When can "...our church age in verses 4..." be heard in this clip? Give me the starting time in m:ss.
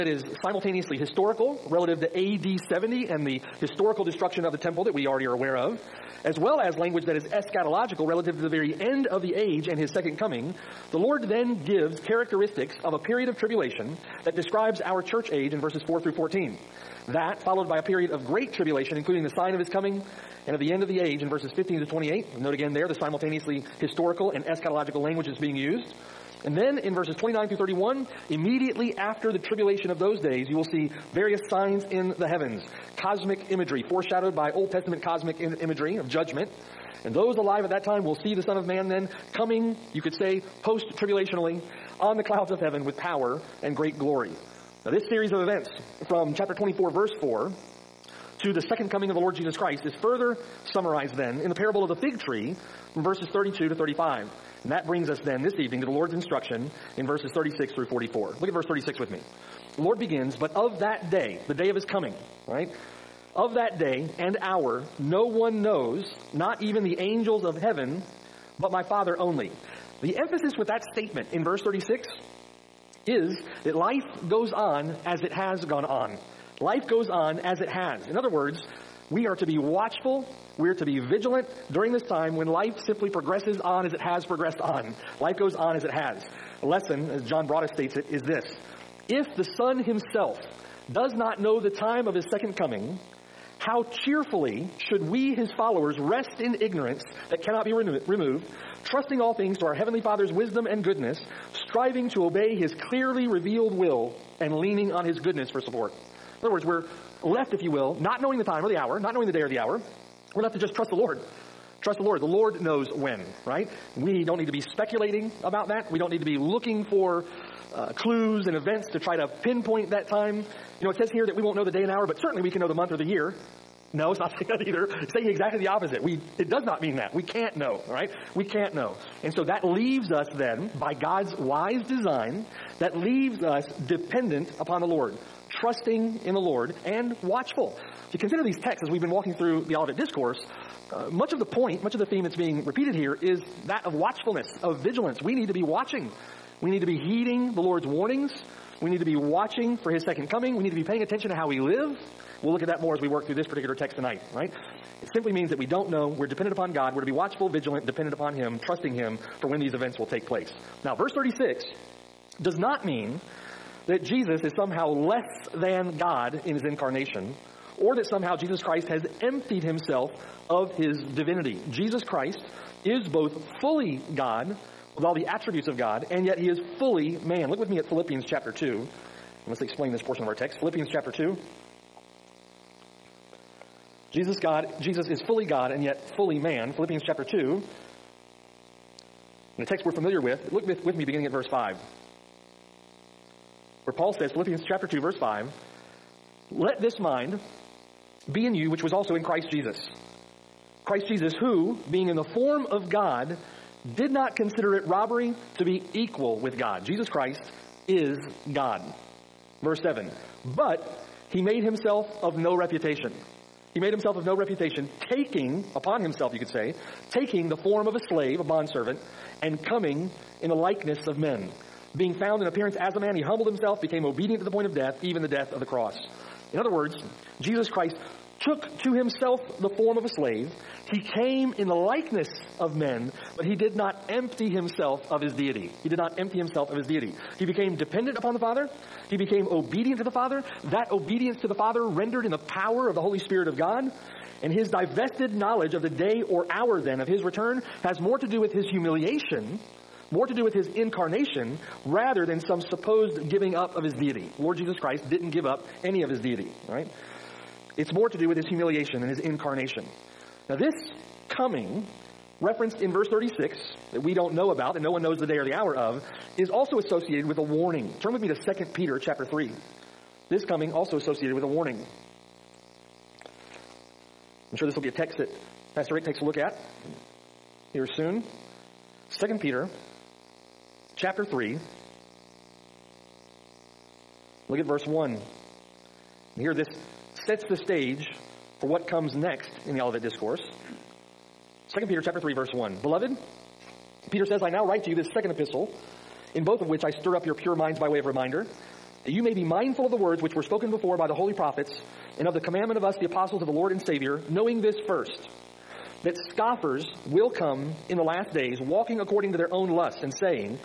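0:14.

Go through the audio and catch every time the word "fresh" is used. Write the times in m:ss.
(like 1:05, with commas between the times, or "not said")
not said.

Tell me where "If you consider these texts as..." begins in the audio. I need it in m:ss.
2:18.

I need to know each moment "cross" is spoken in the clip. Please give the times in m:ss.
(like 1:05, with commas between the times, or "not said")
3:45.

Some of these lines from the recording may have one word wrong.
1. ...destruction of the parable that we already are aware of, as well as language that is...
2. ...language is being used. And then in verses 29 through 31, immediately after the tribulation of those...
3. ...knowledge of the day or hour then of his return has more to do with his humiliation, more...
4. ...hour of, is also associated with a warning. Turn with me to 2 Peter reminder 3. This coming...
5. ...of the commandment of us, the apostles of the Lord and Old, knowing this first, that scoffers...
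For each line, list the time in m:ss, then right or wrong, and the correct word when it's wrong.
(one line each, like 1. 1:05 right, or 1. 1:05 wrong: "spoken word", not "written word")
1. 0:04 wrong: "temple", not "parable"
2. 0:25 right
3. 4:05 right
4. 4:25 wrong: "chapter", not "reminder"
5. 5:02 wrong: "Savior", not "Old".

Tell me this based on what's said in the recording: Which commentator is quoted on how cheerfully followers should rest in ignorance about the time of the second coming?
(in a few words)
John Broadus.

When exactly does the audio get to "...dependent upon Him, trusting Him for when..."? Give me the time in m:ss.
2:37.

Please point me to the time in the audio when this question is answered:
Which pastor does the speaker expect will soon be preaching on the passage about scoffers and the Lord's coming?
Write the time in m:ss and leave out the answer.
4:35.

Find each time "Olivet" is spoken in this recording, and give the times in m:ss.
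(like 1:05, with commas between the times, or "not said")
2:19, 4:49.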